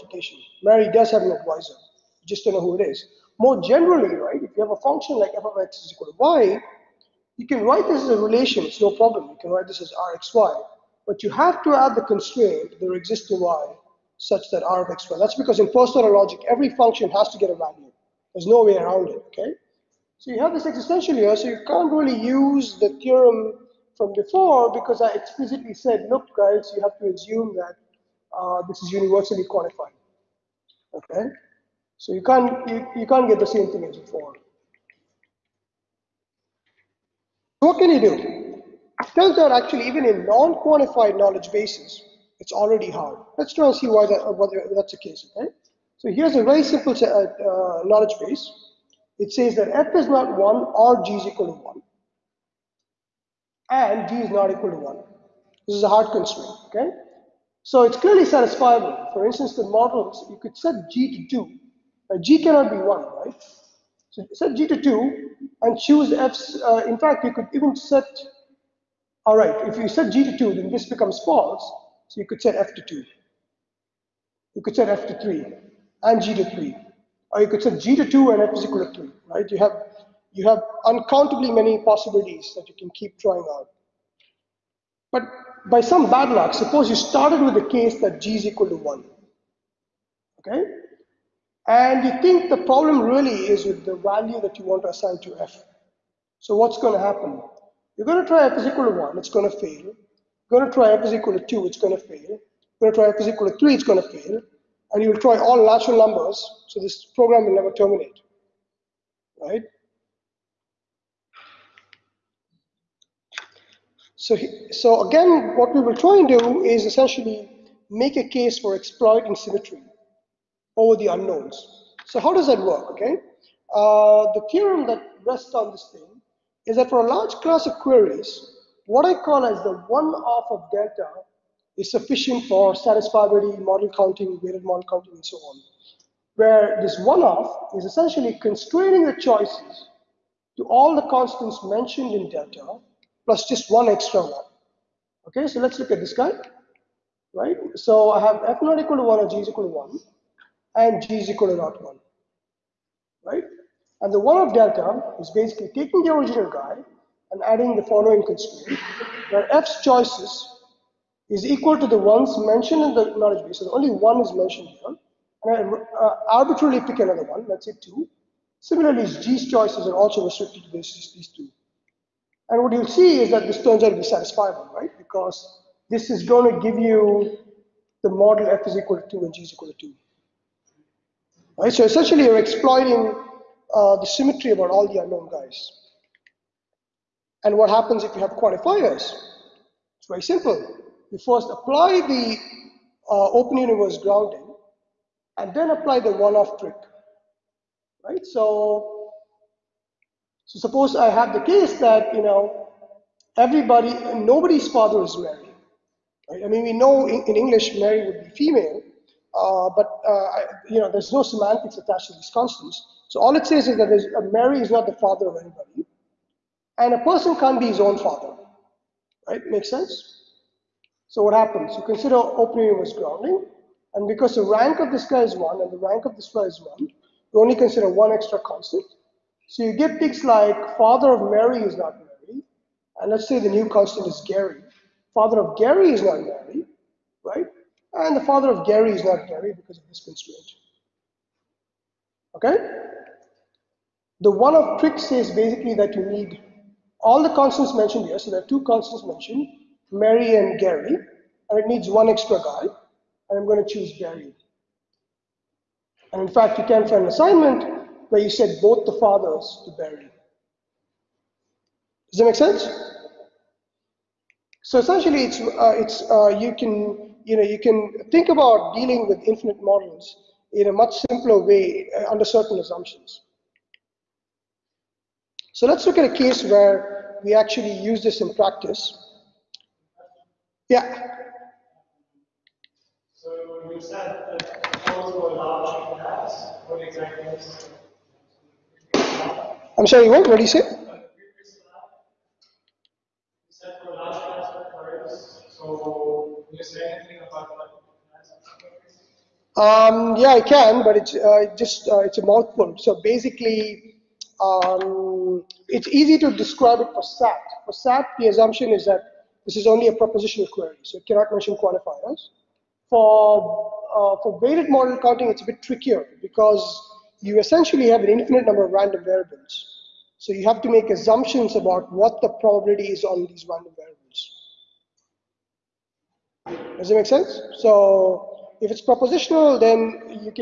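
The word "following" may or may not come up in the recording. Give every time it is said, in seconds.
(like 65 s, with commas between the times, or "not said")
157 s.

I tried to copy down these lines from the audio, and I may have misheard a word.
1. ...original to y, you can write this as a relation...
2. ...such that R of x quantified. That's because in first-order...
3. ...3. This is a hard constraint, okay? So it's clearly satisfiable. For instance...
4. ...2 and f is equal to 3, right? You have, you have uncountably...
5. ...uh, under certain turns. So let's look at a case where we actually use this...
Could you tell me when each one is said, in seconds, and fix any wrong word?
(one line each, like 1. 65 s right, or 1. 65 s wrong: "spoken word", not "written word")
1. 5 s wrong: "equal", not "original"
2. 14 s wrong: "squared", not "quantified"
3. 54 s wrong: "1", not "3"
4. 78 s right
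5. 271 s wrong: "assumptions", not "turns".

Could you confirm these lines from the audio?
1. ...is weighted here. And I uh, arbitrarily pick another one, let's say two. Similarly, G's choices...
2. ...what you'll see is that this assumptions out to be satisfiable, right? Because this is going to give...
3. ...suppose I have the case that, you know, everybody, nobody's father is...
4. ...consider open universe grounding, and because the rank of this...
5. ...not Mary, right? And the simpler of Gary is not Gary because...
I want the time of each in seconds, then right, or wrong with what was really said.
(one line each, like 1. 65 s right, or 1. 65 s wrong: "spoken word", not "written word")
1. 164 s wrong: "mentioned", not "weighted"
2. 172 s wrong: "turns", not "assumptions"
3. 200 s right
4. 221 s right
5. 236 s wrong: "father", not "simpler".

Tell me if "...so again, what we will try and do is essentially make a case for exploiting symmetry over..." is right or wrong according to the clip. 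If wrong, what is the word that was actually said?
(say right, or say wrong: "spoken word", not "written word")
right.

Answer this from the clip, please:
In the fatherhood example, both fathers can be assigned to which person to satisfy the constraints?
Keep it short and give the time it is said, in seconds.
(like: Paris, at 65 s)
Barry, at 259 s.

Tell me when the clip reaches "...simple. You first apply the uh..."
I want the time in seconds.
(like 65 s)
190 s.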